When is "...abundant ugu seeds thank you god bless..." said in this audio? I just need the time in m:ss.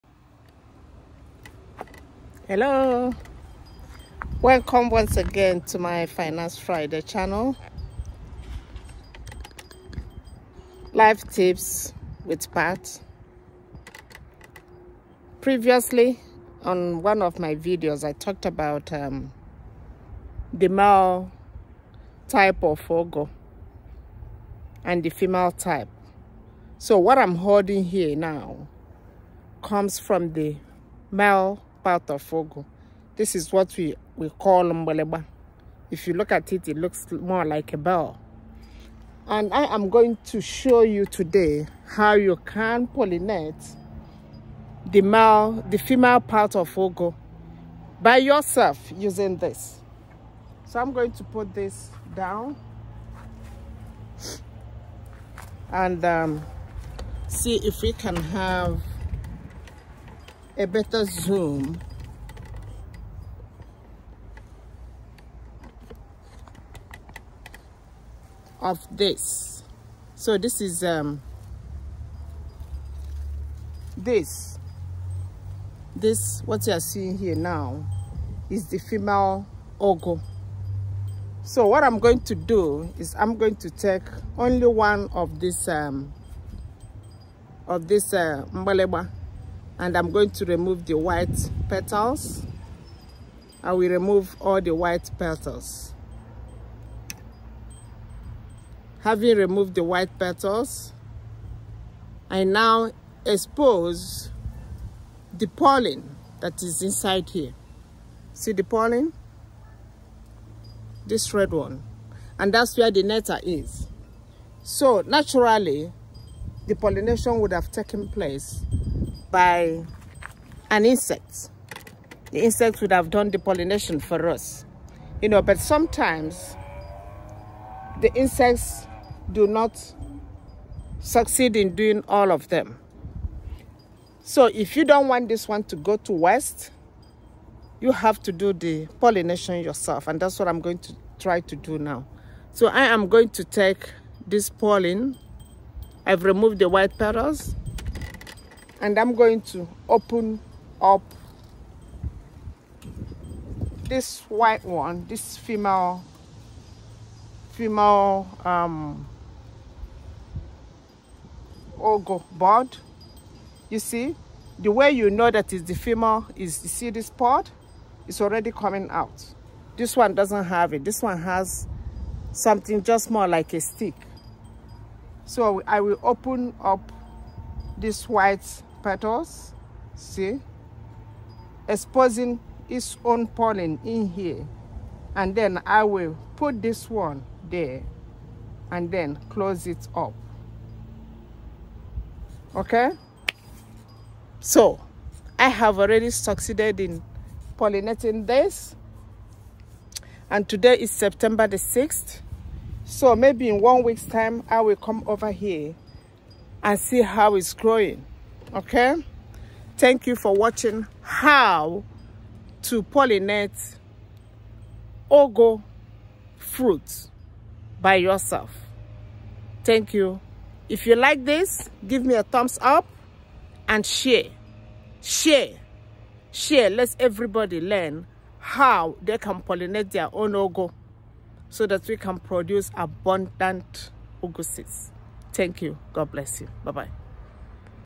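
3:52.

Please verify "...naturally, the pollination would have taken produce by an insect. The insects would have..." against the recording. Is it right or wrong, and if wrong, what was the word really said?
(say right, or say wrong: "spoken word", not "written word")
wrong: "place", not "produce".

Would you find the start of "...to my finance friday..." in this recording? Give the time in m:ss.
0:05.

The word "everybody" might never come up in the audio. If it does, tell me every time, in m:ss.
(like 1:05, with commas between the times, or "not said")
3:46.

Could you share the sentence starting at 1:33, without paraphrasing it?
I will remove all the white petals.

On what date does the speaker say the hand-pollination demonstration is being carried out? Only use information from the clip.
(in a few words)
September 6.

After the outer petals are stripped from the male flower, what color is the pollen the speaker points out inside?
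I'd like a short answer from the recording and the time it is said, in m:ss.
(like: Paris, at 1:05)
Red, at 1:51.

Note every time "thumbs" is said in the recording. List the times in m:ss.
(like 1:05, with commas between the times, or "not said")
3:42.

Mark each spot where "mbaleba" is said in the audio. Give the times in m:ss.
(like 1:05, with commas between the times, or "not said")
0:34, 1:28.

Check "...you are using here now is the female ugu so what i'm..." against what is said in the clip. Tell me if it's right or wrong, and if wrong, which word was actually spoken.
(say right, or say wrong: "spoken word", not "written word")
wrong: "seeing", not "using".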